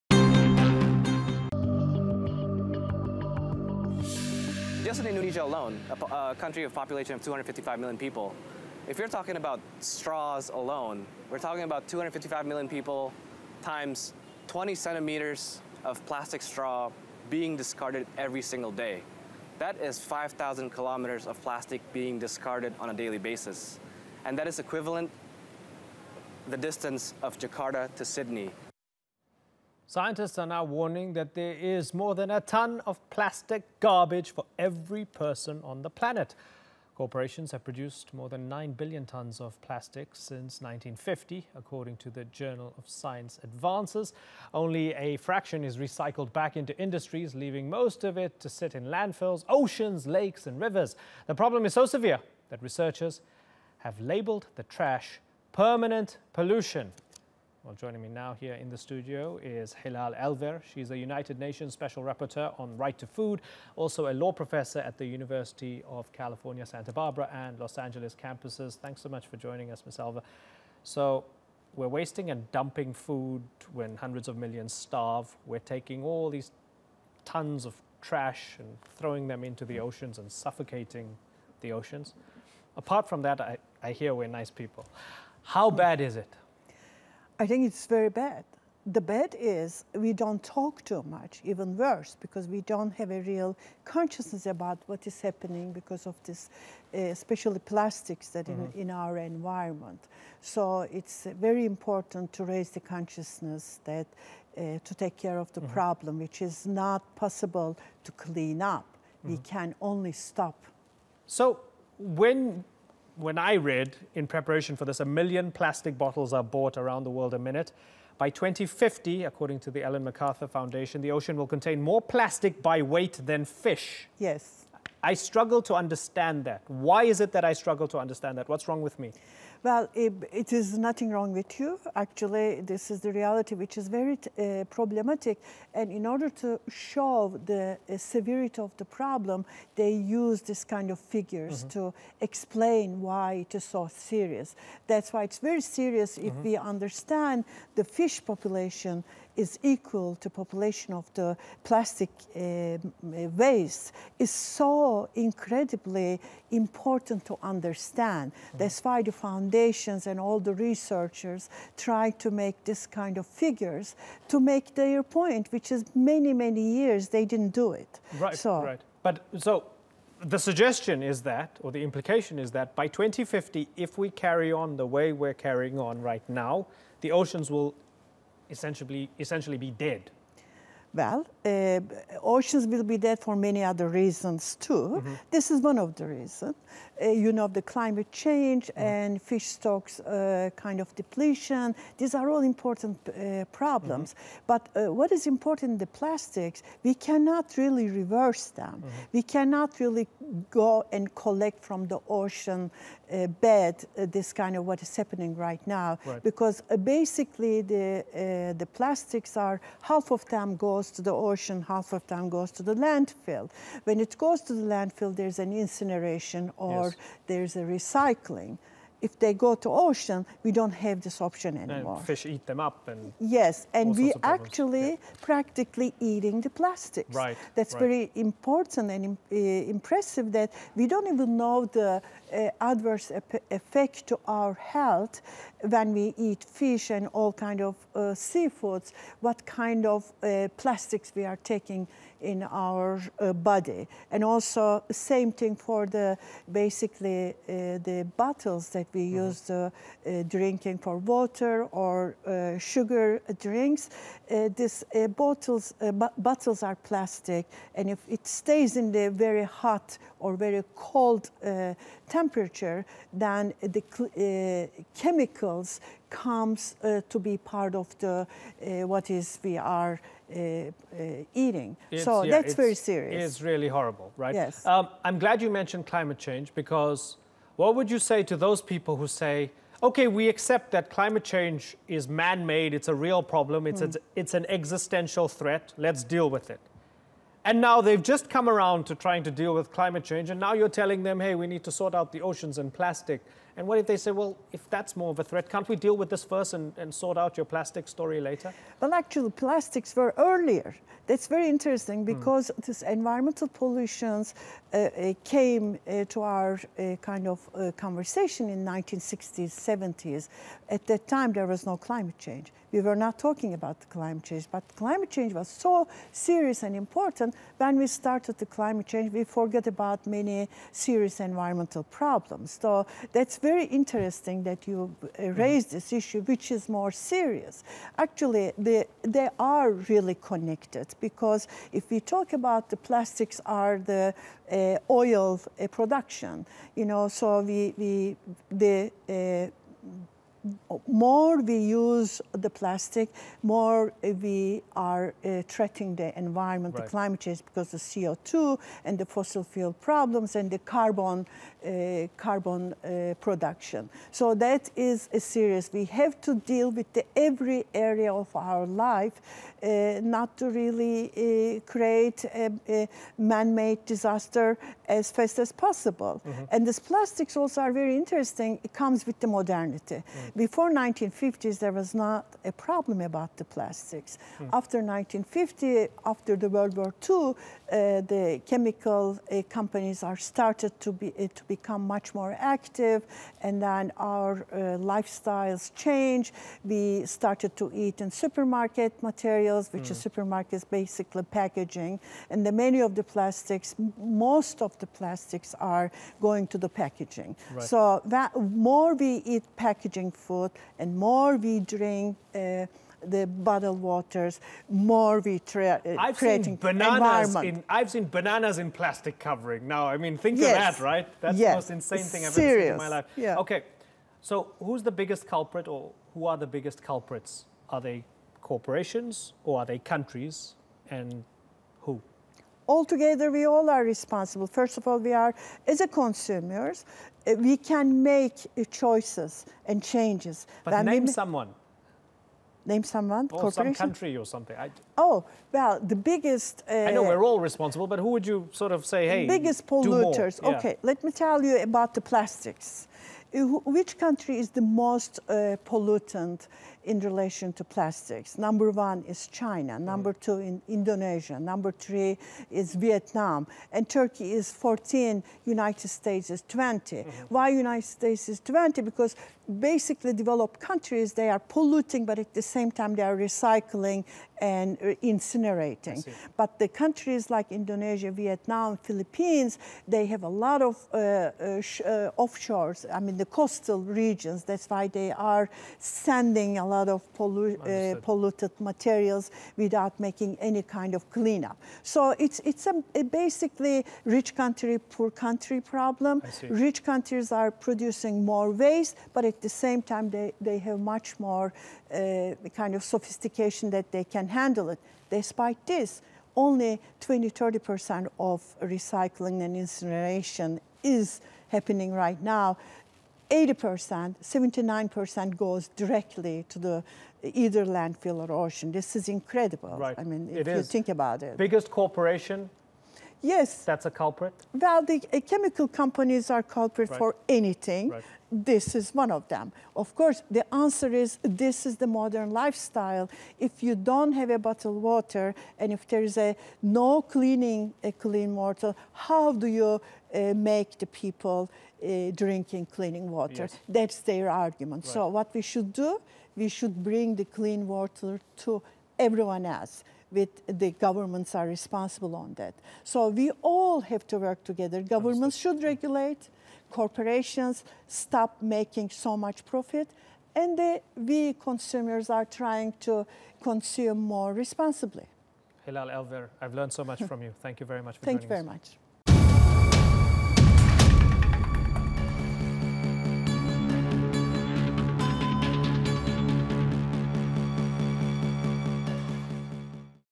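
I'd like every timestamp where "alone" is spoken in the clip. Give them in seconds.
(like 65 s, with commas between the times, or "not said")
5 s, 10 s.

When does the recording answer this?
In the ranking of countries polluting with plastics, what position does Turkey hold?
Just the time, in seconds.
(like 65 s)
454 s.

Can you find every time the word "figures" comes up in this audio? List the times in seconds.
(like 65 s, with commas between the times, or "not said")
141 s, 163 s.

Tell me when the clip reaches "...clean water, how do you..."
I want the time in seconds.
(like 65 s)
527 s.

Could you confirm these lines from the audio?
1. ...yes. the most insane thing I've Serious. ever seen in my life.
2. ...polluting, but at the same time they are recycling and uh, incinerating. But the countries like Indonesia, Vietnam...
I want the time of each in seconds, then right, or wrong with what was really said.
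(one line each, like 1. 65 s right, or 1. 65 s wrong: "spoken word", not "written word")
1. 411 s right
2. 461 s right.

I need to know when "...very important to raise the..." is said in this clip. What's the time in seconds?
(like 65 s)
101 s.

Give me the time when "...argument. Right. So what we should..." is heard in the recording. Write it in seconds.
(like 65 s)
534 s.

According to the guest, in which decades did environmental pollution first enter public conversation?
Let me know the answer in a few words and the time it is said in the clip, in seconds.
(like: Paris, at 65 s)
1960s, 70s, at 308 s.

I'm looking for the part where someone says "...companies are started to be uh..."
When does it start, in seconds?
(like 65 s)
379 s.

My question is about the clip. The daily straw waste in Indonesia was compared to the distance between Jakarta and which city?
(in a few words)
Sydney.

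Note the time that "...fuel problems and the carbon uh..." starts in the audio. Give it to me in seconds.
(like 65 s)
349 s.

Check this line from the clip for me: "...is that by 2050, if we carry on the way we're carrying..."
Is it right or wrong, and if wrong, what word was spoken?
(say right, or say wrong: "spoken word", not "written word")
right.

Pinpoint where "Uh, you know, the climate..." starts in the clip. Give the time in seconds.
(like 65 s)
187 s.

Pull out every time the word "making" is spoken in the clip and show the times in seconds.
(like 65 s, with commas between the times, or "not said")
479 s, 548 s.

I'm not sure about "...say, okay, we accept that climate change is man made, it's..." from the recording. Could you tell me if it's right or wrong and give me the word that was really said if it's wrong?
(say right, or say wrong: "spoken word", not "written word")
right.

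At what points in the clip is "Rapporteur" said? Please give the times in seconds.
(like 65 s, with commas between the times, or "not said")
62 s.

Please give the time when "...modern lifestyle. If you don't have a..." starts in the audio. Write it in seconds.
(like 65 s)
521 s.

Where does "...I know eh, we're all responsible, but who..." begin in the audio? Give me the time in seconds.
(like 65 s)
436 s.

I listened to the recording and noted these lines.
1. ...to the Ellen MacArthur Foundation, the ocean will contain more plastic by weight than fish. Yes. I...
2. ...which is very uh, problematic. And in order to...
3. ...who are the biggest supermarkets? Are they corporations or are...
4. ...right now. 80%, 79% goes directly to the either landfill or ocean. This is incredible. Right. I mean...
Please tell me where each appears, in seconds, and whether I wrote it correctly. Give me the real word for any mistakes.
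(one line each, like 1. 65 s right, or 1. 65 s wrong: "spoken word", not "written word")
1. 119 s right
2. 133 s right
3. 416 s wrong: "culprits", not "supermarkets"
4. 501 s right.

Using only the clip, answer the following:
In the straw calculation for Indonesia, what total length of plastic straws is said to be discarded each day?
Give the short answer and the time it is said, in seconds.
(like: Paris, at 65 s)
5,000 kilometers, at 19 s.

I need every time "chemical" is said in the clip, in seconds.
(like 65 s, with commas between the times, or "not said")
265 s, 378 s, 515 s.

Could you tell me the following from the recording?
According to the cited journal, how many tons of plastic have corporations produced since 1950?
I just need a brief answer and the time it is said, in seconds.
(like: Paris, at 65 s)
9 billion tons, at 38 s.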